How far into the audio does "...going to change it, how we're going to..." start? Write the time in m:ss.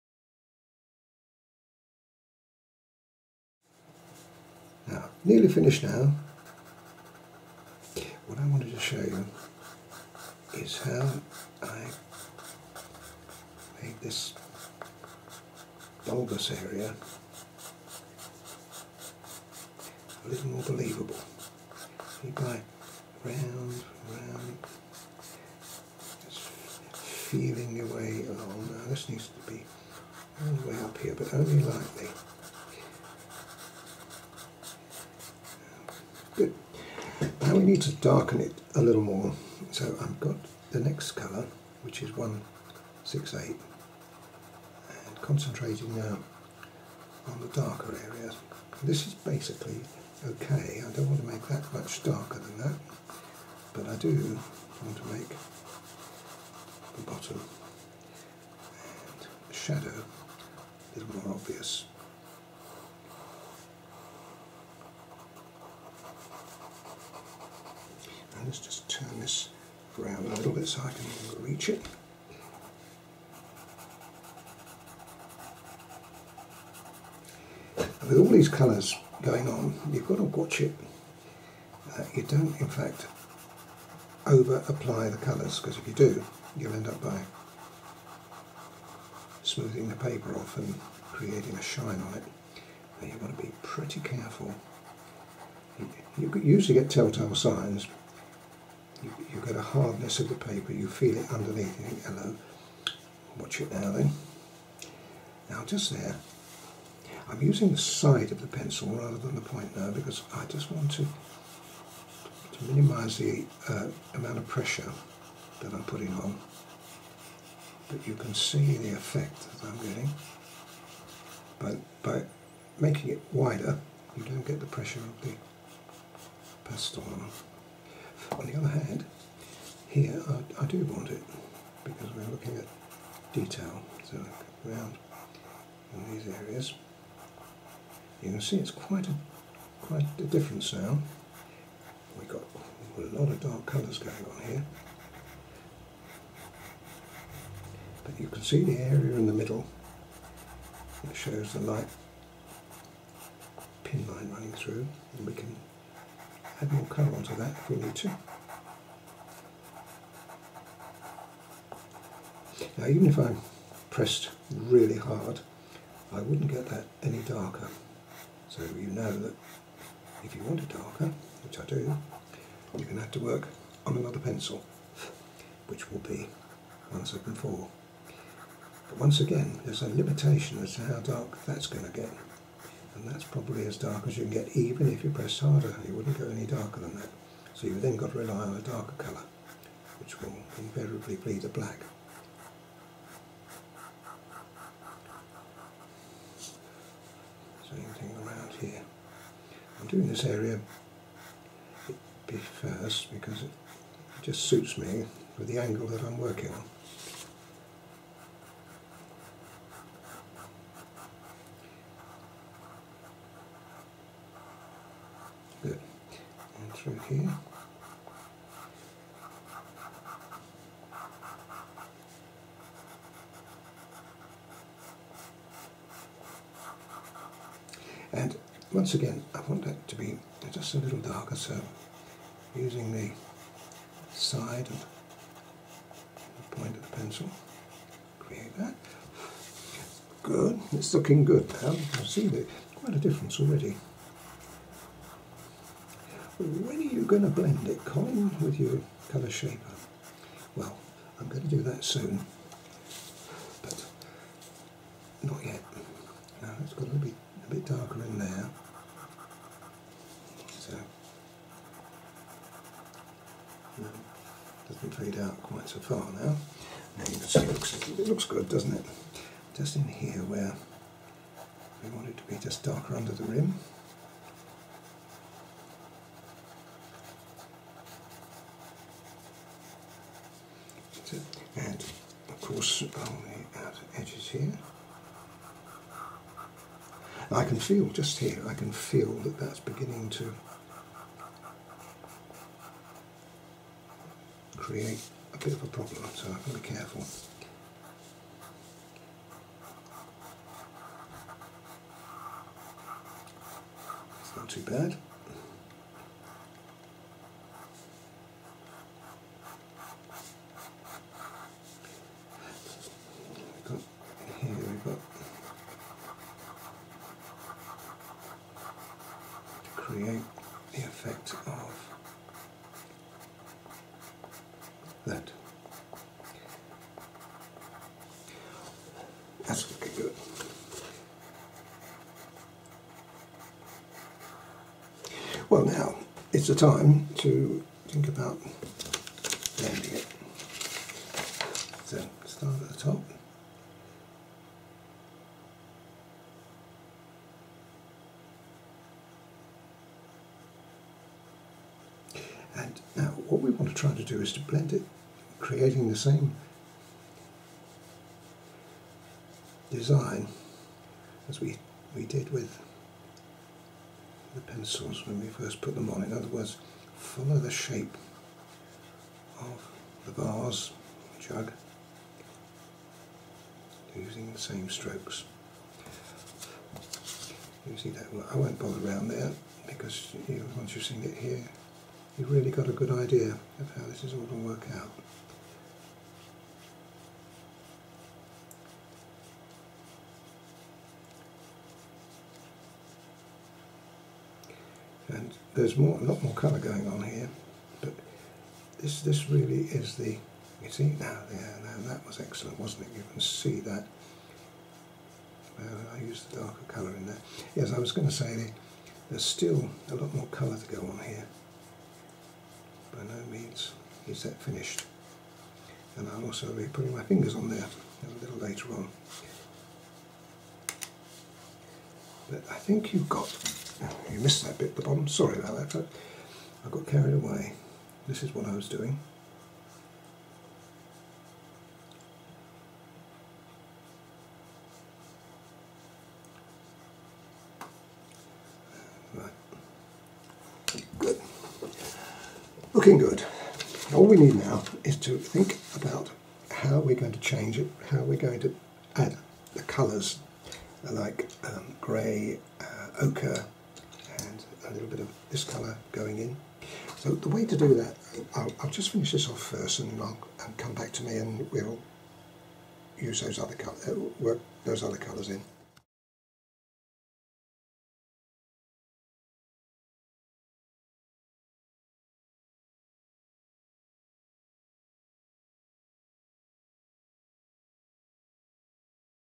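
7:26.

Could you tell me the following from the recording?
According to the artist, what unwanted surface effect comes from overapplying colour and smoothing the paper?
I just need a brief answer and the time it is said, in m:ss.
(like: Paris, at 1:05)
a shine, at 1:31.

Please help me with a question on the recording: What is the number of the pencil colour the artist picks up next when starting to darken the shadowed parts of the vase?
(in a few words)
168.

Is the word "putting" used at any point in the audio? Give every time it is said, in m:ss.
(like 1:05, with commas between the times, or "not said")
1:55, 6:56.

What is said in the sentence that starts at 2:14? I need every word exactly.
So around in these areas, you can see it's quite a quite a difference now.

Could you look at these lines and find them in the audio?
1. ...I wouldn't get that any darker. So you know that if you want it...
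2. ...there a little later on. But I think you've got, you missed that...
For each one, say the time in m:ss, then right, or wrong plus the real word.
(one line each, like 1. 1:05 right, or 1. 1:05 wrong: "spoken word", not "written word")
1. 2:46 right
2. 6:57 right.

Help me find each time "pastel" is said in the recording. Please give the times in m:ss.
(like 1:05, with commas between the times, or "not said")
2:06.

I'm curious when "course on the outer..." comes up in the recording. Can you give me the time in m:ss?
4:42.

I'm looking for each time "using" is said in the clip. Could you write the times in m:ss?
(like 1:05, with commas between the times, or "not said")
1:47, 3:52, 6:13.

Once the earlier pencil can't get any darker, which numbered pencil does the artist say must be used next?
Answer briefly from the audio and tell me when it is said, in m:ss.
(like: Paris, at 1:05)
174, at 2:56.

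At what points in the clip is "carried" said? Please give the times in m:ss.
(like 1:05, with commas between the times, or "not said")
7:06.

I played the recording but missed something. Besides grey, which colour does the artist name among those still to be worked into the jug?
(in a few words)
ochre.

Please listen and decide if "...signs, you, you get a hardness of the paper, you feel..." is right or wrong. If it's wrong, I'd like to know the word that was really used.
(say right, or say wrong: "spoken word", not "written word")
right.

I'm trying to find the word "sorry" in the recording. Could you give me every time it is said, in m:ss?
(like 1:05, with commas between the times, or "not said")
7:05.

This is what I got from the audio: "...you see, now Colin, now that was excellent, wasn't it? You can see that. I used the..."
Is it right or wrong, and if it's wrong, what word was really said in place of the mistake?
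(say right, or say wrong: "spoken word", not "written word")
wrong: "Yeah", not "Colin".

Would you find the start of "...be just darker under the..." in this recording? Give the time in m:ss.
4:32.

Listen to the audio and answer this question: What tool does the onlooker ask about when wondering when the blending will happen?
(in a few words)
colour shaper.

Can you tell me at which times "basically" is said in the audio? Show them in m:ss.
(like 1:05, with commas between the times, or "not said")
0:49.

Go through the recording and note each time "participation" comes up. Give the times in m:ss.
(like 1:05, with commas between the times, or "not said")
not said.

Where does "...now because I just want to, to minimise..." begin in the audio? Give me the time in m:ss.
1:49.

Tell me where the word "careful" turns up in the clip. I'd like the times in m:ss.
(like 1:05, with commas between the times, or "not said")
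1:34, 4:56.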